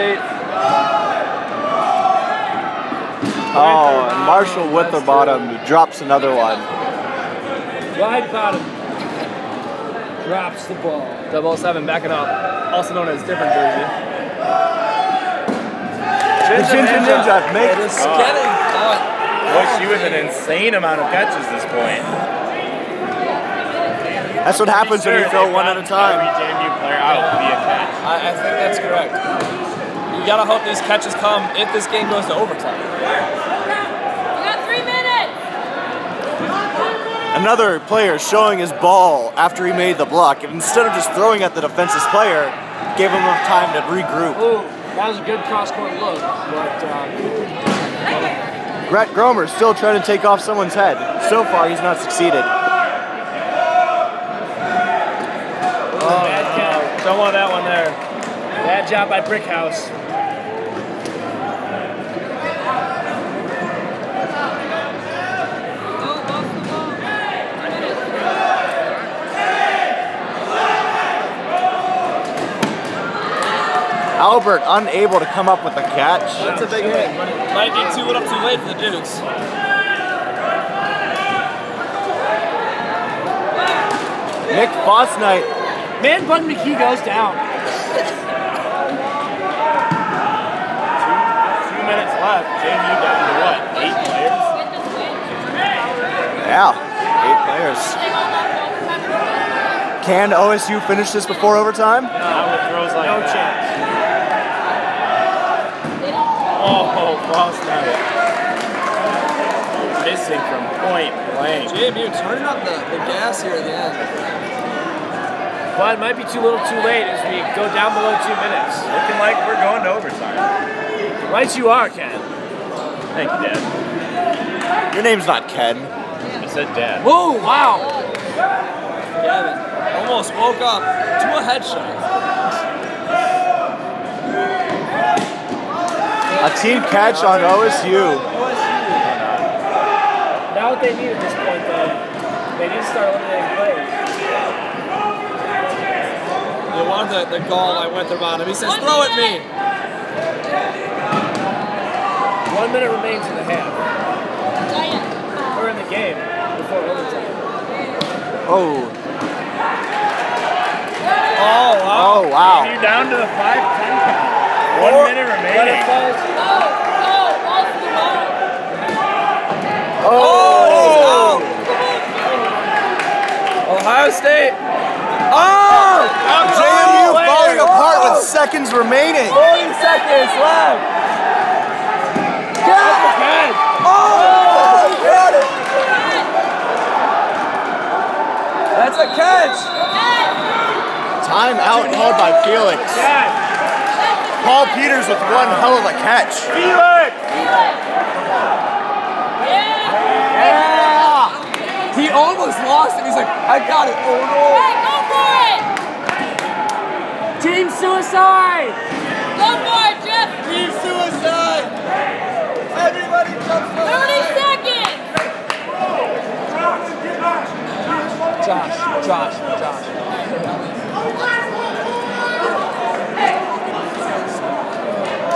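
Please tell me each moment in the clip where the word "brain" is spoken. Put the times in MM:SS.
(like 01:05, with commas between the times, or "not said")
not said.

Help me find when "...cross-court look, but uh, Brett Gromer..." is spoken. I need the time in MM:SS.
00:45.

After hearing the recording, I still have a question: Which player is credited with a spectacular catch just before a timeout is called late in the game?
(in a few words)
Paul Peters.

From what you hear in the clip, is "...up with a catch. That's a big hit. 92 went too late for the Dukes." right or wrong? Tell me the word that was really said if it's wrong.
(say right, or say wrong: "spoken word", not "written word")
right.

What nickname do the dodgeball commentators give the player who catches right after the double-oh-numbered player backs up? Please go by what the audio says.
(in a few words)
Ginger Ninja.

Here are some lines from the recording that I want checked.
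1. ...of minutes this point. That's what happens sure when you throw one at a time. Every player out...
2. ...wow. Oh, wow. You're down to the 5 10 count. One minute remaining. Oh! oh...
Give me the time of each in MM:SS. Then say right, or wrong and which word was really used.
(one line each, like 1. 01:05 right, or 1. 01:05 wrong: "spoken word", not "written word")
1. 00:21 wrong: "catches", not "minutes"
2. 02:41 right.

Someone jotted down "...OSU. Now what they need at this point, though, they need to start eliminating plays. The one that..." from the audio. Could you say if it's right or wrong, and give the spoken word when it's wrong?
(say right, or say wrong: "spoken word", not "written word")
right.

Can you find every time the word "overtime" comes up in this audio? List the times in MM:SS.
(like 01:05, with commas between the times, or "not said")
00:32, 01:41, 01:59, 02:36.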